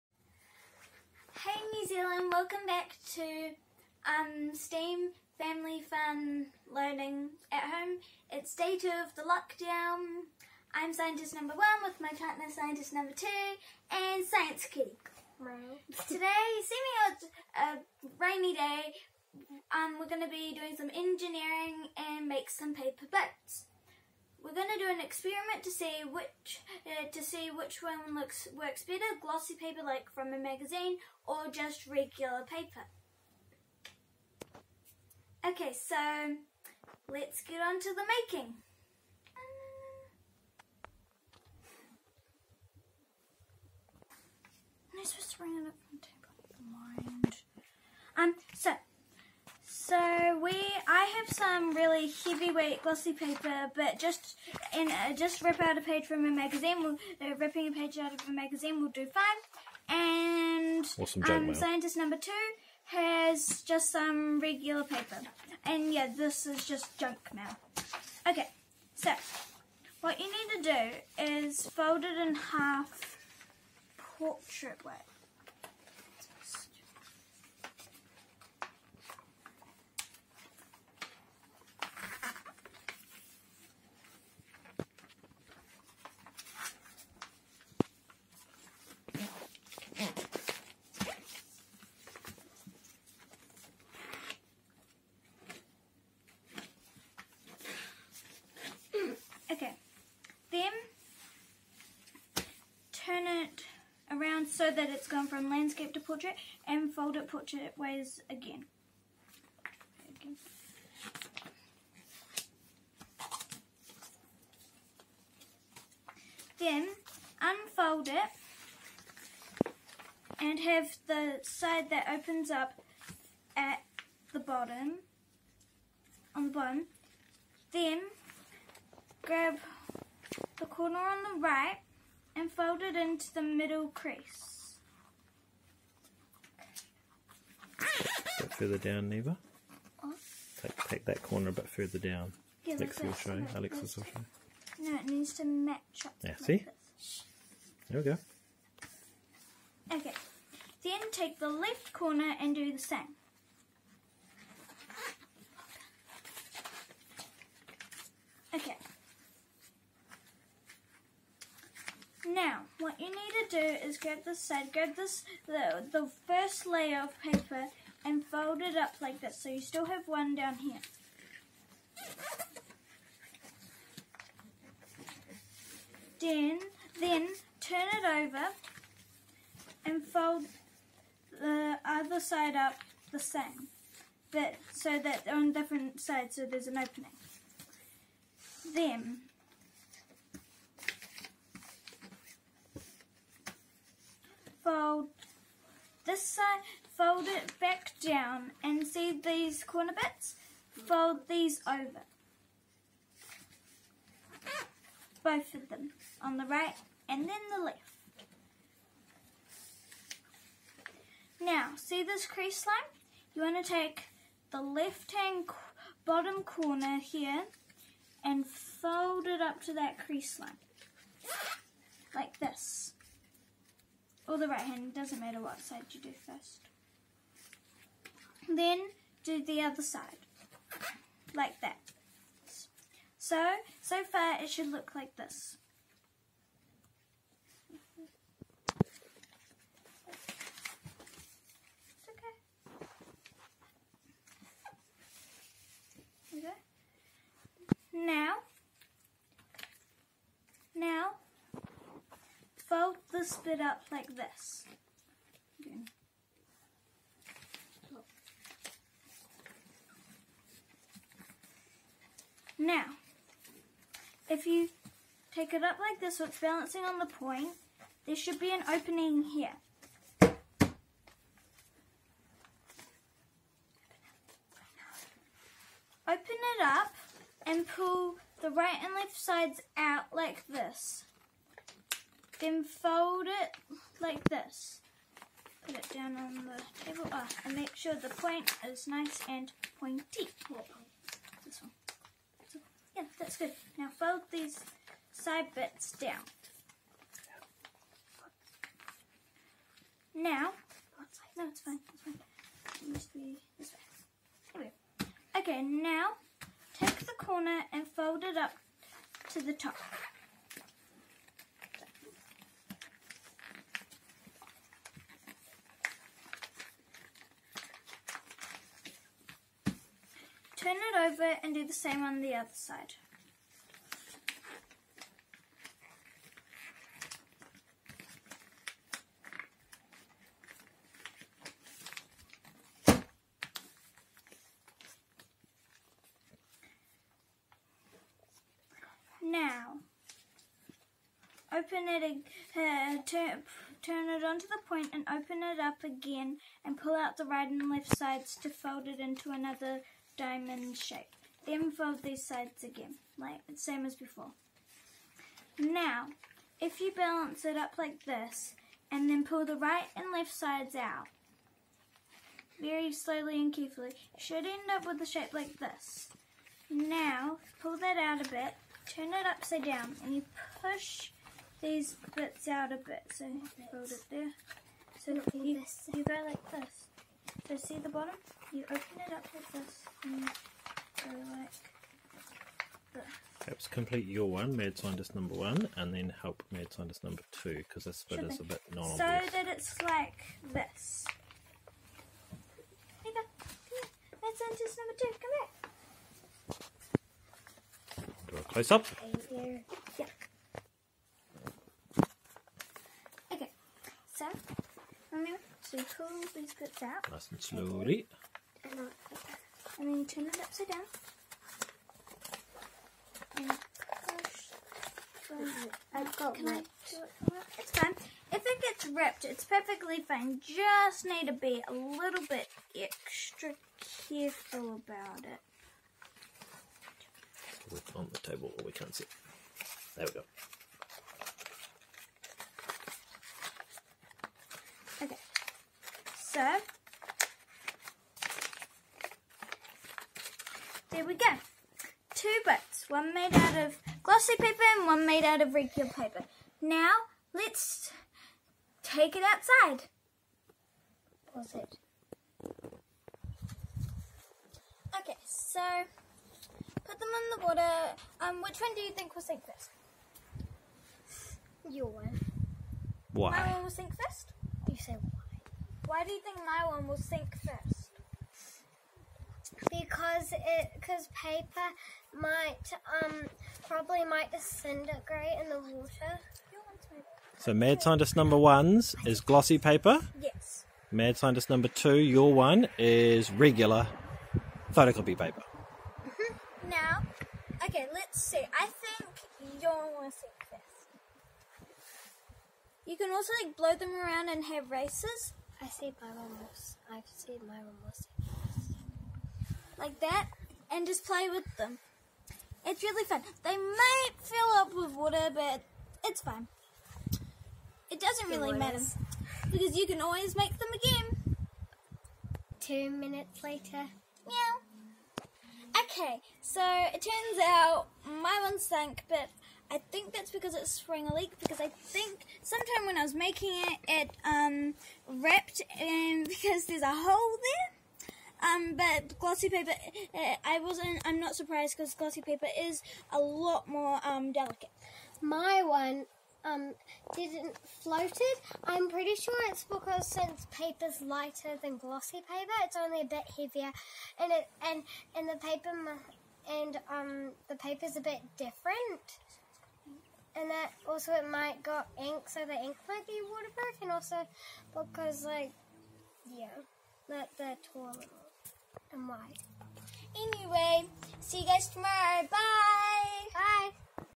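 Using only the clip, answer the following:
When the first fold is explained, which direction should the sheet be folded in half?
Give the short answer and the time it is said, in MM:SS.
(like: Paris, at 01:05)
Portrait way, at 01:14.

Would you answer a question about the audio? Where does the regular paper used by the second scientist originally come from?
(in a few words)
Junk mail.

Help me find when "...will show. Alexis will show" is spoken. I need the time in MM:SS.
02:23.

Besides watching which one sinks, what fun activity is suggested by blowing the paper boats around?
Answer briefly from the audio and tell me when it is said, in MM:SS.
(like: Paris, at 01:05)
Races, at 08:14.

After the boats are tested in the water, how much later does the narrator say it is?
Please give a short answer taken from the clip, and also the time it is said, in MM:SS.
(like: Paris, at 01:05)
Two minutes, at 08:32.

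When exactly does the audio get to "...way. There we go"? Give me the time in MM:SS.
05:03.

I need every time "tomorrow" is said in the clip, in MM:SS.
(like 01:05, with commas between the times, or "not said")
09:21.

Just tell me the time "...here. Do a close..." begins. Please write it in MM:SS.
06:38.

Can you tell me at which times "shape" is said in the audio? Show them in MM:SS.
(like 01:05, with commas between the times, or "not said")
05:50, 06:05.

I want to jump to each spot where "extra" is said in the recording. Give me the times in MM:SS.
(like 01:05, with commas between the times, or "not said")
07:02.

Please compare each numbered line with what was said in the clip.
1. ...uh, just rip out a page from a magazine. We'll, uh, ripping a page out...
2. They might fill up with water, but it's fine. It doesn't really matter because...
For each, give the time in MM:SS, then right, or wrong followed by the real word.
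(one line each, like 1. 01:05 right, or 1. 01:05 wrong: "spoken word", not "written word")
1. 00:54 right
2. 08:23 right.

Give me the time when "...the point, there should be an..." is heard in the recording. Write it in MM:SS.
04:26.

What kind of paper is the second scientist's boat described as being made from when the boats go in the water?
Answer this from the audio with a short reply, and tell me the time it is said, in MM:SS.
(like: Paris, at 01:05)
Regular photocopy paper, at 08:03.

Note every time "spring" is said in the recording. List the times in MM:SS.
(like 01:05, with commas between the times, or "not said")
08:40.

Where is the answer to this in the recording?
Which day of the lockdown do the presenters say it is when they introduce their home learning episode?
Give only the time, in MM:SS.
00:08.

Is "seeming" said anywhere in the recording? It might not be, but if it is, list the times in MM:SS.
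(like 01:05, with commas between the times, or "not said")
00:16.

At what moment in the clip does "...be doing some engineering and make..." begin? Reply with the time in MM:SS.
00:20.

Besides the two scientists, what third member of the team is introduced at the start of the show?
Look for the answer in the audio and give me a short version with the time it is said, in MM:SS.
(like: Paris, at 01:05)
Science kitty, at 00:14.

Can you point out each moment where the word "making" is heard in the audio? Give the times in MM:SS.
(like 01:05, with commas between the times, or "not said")
00:38, 08:43.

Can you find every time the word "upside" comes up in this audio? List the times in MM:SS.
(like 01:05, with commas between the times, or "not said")
06:09, 06:50.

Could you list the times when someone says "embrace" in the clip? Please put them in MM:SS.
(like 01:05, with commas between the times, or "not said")
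not said.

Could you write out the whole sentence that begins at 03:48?
Then do the other side, like that.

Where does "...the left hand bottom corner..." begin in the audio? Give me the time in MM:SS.
03:34.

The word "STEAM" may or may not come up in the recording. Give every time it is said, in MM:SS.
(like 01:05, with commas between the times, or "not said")
00:04.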